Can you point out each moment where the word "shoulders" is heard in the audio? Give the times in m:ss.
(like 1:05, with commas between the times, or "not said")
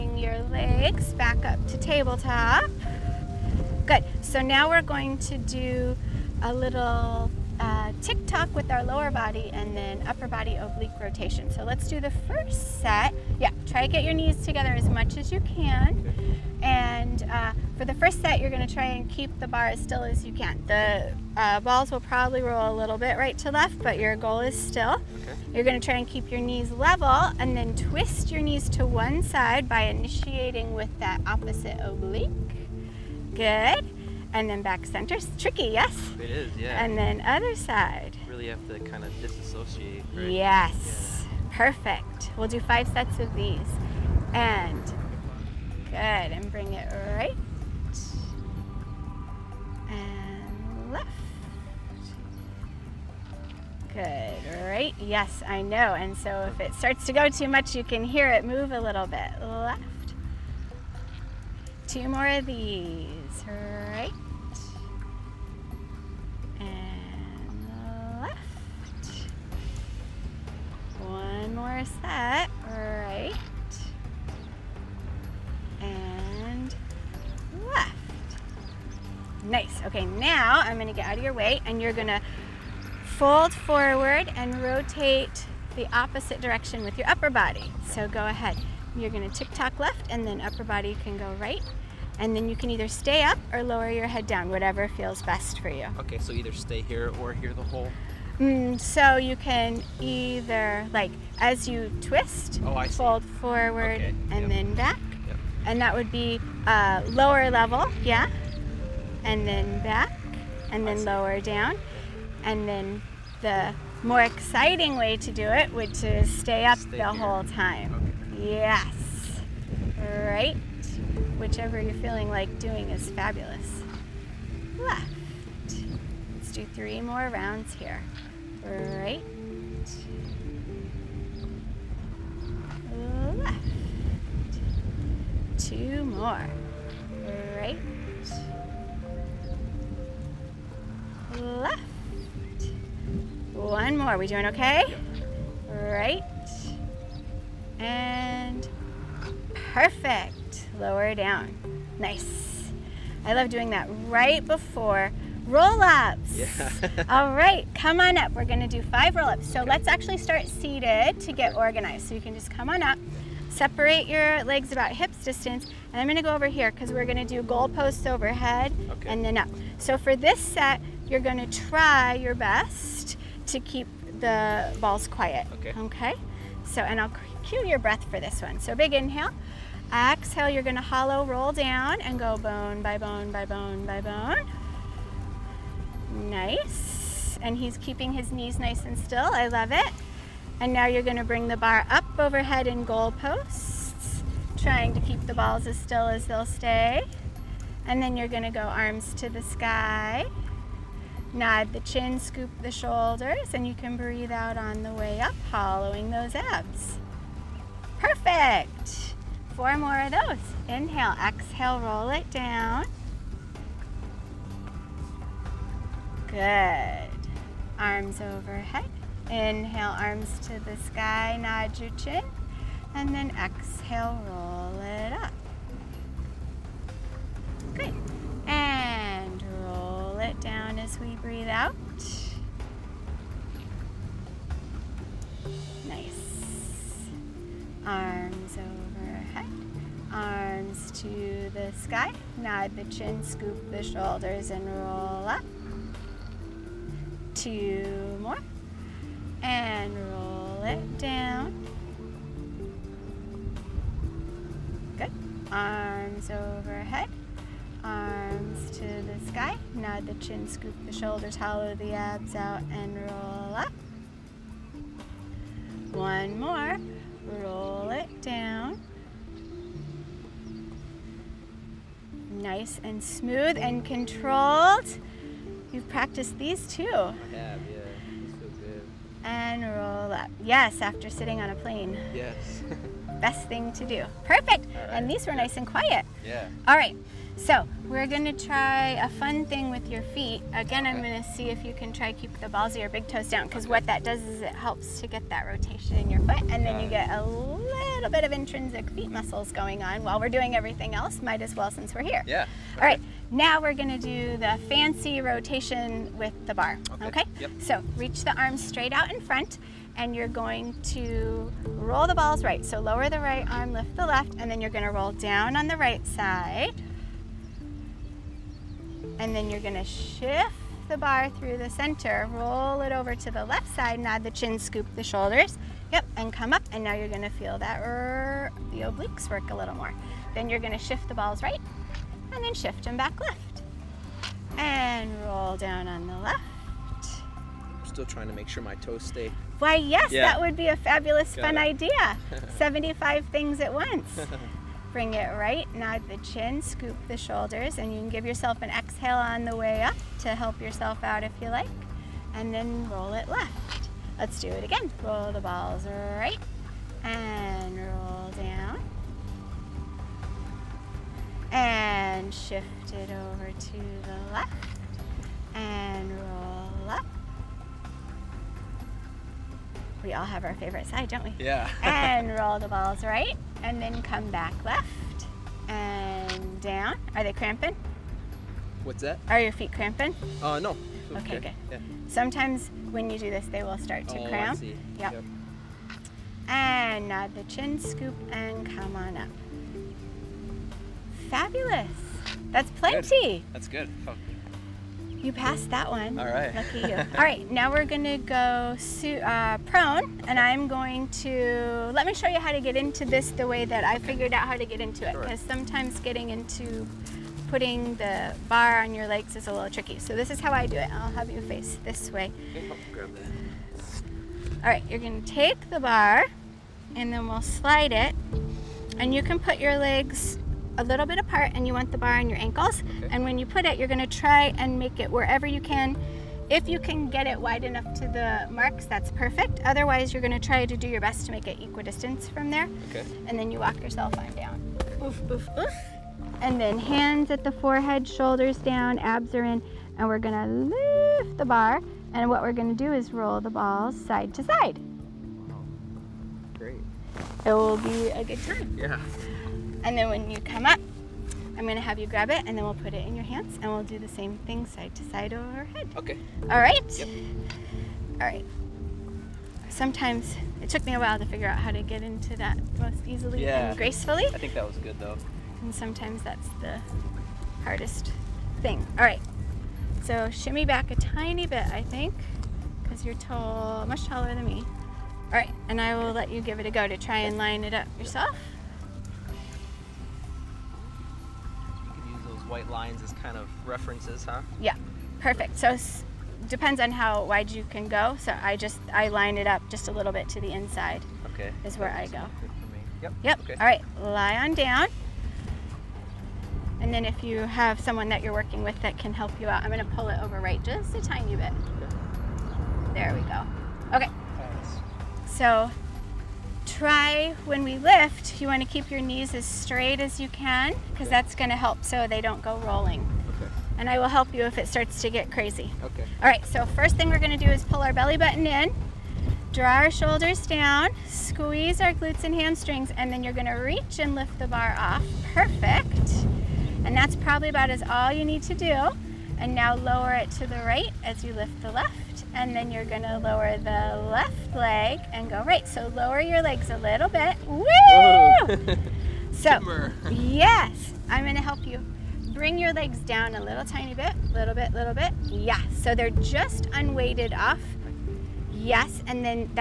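3:22, 4:03, 4:20, 5:25, 5:47, 7:18, 8:39.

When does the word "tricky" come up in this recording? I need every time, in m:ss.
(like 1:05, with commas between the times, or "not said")
0:35, 6:49.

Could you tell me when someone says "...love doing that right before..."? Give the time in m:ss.
2:33.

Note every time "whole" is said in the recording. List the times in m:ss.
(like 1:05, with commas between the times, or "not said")
1:37, 1:57.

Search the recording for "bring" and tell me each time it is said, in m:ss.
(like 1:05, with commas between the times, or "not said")
0:46, 3:11, 5:44, 9:02.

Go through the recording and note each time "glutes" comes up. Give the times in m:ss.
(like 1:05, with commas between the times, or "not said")
8:41.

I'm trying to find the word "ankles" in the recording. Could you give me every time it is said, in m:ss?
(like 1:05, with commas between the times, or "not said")
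7:02.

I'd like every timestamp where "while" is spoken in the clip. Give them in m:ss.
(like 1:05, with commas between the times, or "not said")
5:00, 7:40.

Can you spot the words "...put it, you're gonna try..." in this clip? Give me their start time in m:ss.
7:03.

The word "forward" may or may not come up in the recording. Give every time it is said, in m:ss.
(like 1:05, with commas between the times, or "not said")
1:23, 1:43.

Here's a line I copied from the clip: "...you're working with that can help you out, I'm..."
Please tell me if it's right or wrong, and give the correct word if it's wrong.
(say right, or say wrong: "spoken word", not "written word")
right.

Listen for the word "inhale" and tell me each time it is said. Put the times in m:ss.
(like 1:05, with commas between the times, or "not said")
2:58, 3:30, 3:39.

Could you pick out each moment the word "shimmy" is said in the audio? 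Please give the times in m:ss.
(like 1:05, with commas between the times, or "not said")
7:50.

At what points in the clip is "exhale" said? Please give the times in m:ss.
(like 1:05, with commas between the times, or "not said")
2:59, 3:31, 3:43, 5:48.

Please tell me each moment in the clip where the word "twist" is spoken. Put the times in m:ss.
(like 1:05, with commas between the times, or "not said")
0:27, 1:42.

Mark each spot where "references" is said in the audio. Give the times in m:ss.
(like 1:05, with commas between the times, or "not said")
8:03.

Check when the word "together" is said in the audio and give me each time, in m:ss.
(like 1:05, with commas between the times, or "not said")
0:14.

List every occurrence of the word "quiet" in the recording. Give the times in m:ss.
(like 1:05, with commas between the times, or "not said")
2:55, 4:45.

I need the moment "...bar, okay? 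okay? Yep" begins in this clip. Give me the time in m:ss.
5:06.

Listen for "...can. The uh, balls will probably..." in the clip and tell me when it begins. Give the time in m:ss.
0:20.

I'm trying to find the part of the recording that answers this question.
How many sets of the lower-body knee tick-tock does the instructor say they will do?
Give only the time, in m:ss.
0:42.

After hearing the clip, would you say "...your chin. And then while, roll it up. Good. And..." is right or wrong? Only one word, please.
wrong.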